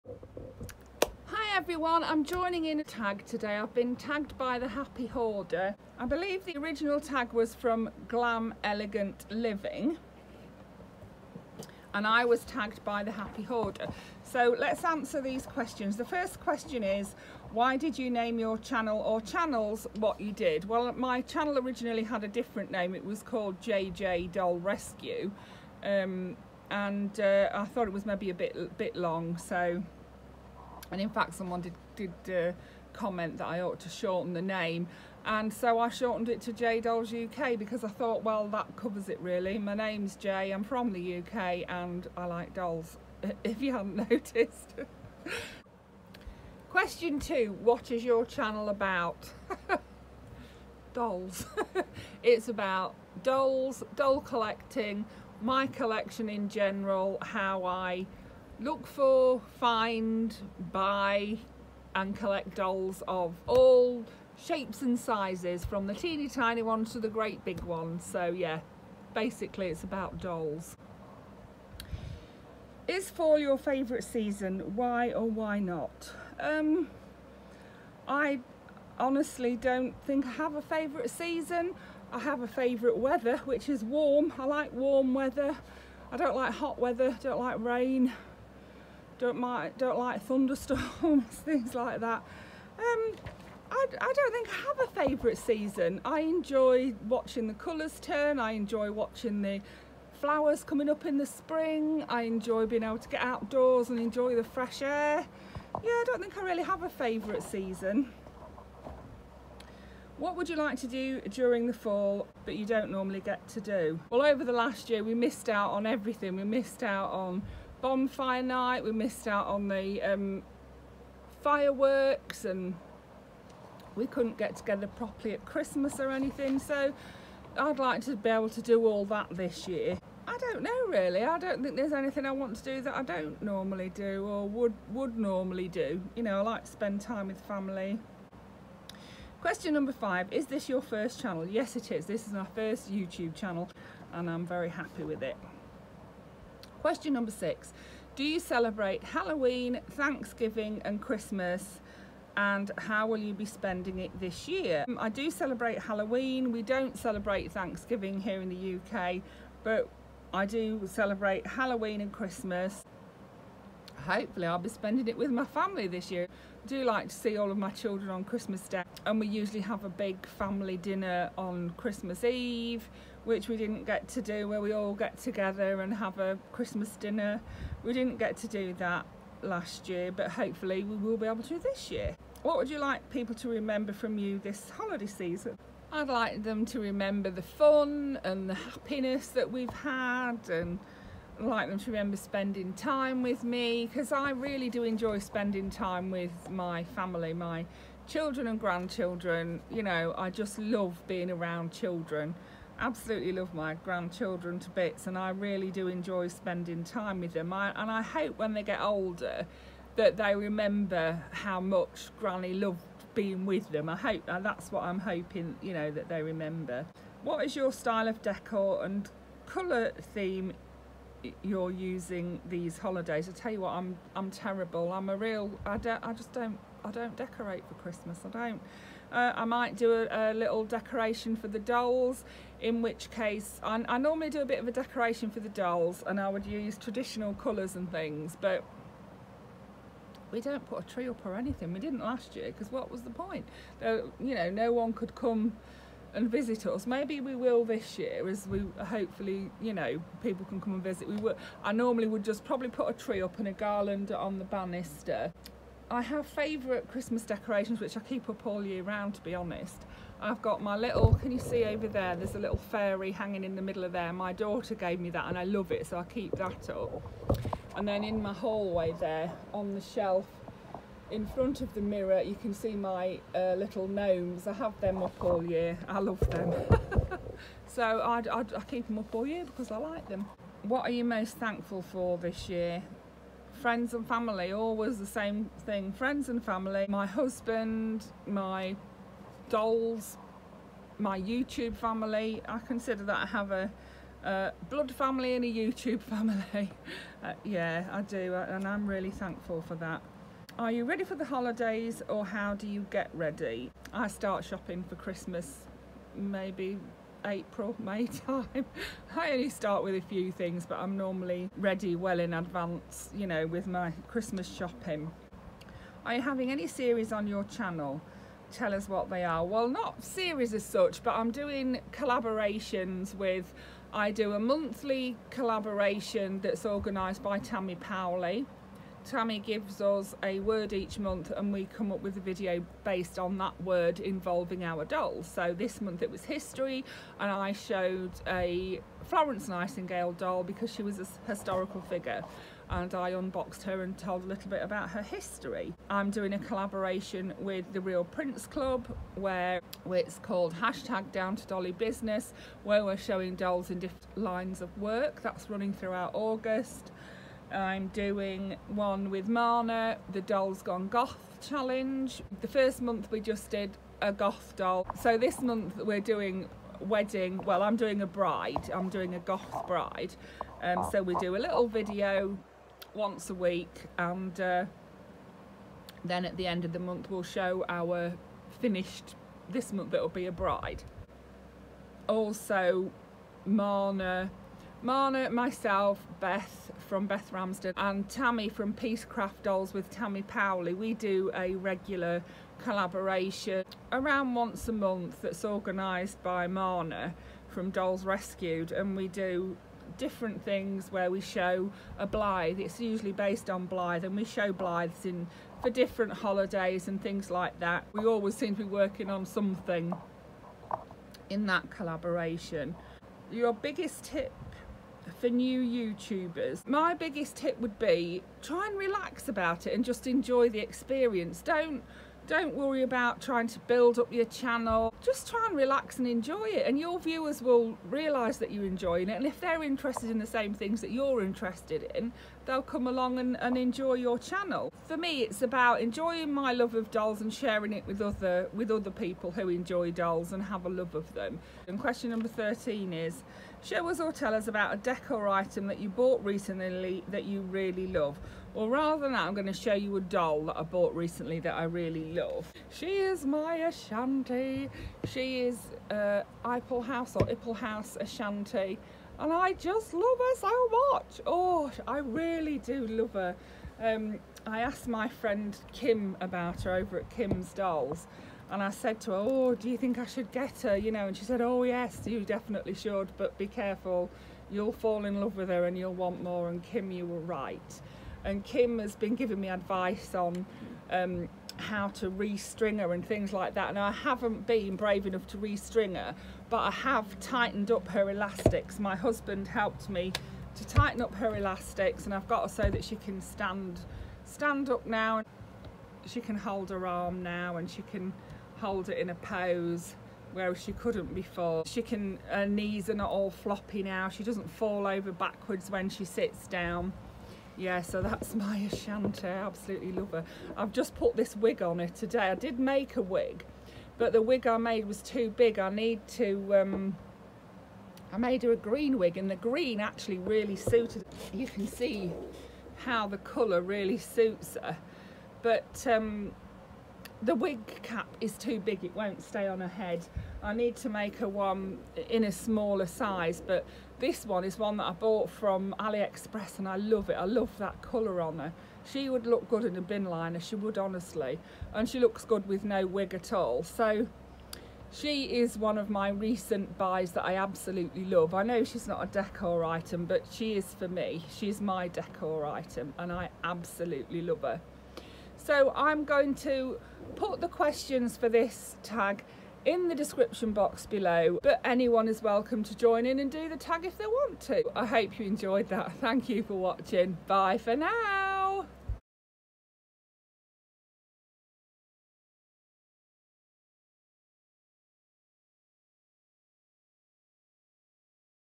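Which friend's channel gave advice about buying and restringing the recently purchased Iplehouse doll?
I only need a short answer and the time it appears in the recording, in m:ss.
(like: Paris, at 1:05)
Kim's Dolls, at 7:47.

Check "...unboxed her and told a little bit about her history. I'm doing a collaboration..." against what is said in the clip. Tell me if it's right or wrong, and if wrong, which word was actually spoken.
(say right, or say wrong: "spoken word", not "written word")
right.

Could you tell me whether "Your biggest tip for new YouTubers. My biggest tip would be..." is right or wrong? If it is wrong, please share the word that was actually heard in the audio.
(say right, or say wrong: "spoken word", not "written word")
right.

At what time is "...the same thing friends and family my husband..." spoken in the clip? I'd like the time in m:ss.
4:44.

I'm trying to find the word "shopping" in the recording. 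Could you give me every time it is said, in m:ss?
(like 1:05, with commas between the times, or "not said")
5:04, 5:14.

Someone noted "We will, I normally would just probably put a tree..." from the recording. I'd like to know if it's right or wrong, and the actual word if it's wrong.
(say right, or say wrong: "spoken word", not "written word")
right.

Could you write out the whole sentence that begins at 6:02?
The first month we just did a goth doll.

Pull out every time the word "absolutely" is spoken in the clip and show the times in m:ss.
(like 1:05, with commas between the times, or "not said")
3:22, 8:29, 9:07, 9:13.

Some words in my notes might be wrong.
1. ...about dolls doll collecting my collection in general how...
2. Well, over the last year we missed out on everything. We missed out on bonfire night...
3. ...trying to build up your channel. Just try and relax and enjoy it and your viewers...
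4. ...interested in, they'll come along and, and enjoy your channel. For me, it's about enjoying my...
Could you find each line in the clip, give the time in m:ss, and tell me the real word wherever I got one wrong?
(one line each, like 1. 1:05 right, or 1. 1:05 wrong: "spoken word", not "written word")
1. 0:52 right
2. 1:54 right
3. 7:03 right
4. 7:11 right.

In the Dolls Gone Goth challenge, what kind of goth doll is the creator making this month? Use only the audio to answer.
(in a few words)
a goth bride.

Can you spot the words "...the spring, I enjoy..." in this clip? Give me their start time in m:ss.
1:41.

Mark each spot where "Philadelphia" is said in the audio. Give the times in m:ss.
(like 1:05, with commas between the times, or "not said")
not said.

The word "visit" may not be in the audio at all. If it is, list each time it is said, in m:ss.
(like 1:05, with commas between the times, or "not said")
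4:06, 4:10.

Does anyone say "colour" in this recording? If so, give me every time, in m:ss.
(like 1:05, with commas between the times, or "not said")
1:37, 3:39, 3:57, 8:43, 8:57.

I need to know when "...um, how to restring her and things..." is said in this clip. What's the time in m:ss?
8:00.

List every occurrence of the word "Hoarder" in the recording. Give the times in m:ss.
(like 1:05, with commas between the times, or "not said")
0:05, 0:13.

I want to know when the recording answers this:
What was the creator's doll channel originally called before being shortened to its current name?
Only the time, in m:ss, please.
0:23.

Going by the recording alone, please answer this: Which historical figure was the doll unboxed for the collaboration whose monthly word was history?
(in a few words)
Florence Nightingale.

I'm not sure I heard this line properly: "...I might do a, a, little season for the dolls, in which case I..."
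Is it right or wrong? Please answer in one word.
wrong.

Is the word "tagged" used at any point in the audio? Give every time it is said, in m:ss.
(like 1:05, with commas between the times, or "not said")
0:03, 0:12.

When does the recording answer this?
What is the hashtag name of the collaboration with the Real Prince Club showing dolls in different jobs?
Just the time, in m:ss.
5:51.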